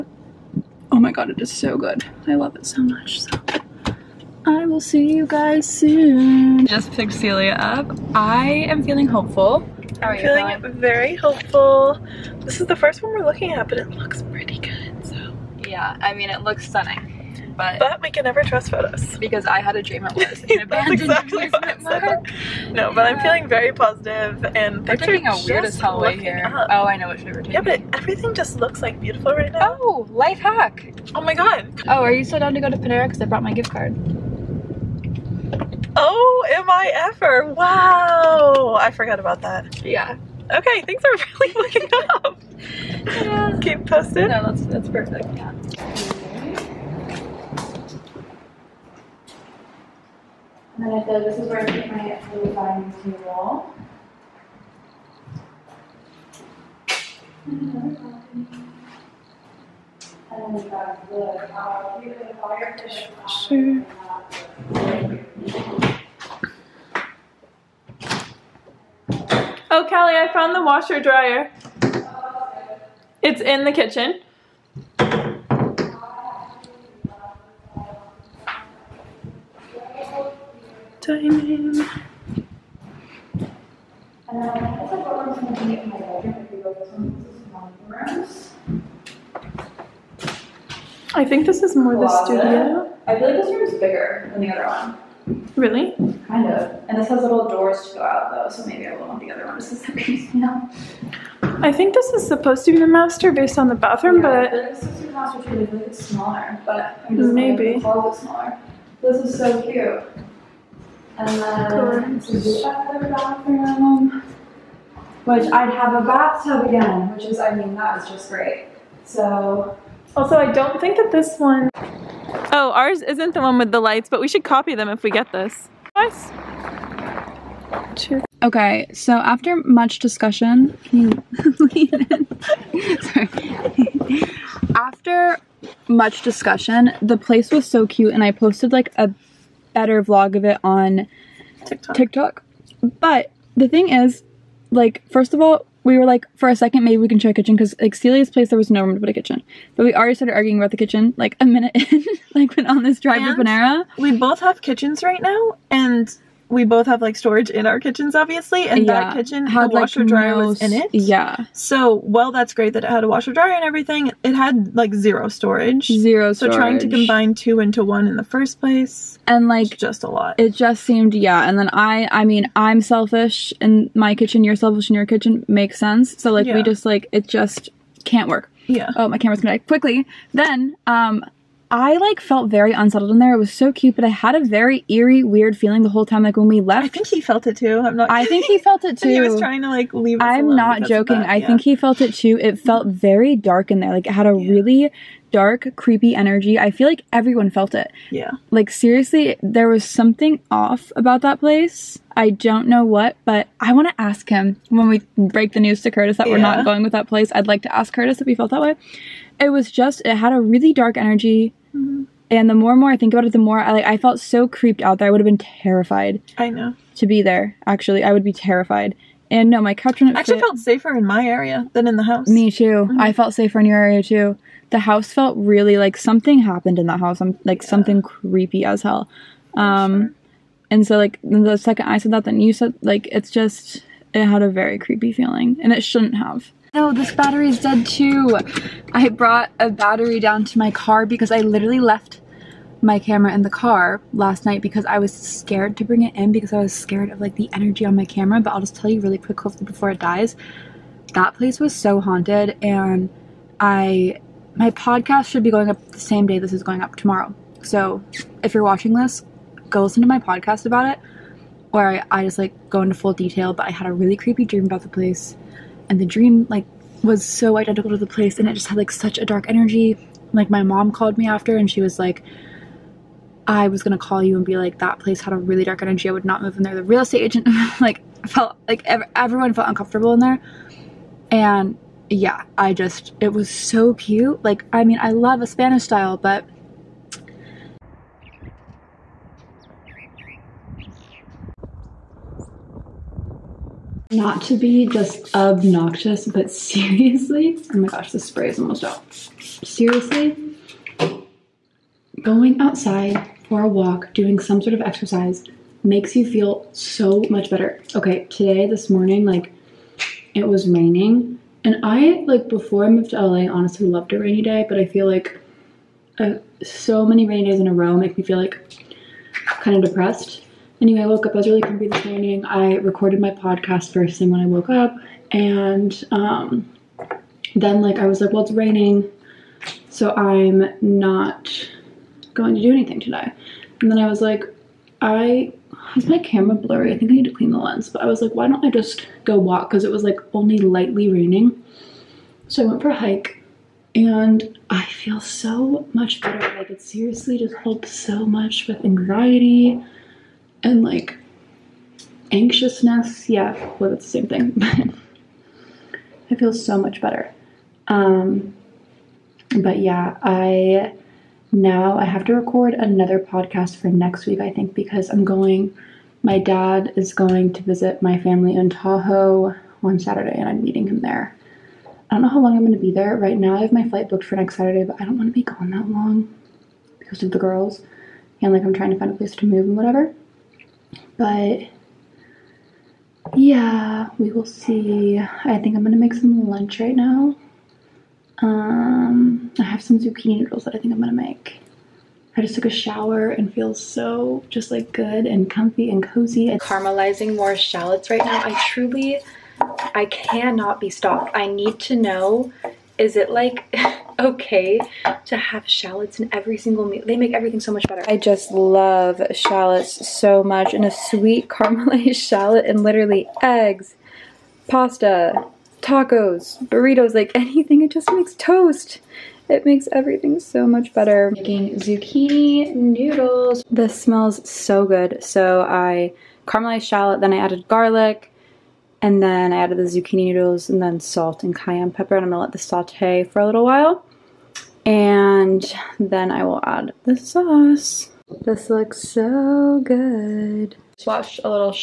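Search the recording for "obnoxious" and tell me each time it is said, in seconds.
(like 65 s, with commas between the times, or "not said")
295 s.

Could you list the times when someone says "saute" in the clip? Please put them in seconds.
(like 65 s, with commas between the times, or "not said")
432 s.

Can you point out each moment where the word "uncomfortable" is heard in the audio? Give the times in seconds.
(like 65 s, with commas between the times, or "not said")
279 s.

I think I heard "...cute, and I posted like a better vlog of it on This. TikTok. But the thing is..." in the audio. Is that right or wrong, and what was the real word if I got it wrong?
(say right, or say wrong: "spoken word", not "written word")
wrong: "TikTok", not "This".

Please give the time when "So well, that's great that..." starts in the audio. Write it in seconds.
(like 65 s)
161 s.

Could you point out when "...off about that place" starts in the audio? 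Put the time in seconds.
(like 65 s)
200 s.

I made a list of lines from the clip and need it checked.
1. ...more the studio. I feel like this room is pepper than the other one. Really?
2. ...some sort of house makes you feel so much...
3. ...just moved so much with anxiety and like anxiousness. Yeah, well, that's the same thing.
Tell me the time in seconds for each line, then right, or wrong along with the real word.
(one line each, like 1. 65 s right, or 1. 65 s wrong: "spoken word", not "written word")
1. 91 s wrong: "bigger", not "pepper"
2. 304 s wrong: "exercise", not "house"
3. 347 s wrong: "helped", not "moved".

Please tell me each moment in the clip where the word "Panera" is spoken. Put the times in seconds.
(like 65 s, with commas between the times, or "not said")
32 s, 153 s.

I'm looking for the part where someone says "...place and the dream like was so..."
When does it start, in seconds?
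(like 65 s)
264 s.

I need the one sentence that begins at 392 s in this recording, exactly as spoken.
I just took a shower and feel so just like good and comfy and cozy.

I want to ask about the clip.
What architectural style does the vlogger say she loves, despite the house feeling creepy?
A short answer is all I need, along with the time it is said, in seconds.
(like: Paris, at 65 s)
Spanish style, at 285 s.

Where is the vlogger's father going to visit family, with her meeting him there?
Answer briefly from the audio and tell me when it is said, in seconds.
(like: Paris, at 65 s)
Tahoe, at 368 s.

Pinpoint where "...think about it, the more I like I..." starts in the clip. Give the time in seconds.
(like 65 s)
212 s.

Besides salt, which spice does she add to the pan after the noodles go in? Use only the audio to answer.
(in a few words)
cayenne pepper.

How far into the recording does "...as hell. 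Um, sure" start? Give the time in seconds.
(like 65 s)
228 s.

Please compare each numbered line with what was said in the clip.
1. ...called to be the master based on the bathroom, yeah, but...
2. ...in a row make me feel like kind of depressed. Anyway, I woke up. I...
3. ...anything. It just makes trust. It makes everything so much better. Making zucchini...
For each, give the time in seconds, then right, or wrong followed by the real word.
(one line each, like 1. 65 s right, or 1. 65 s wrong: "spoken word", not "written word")
1. 102 s wrong: "supposed", not "called"
2. 317 s right
3. 417 s wrong: "toast", not "trust".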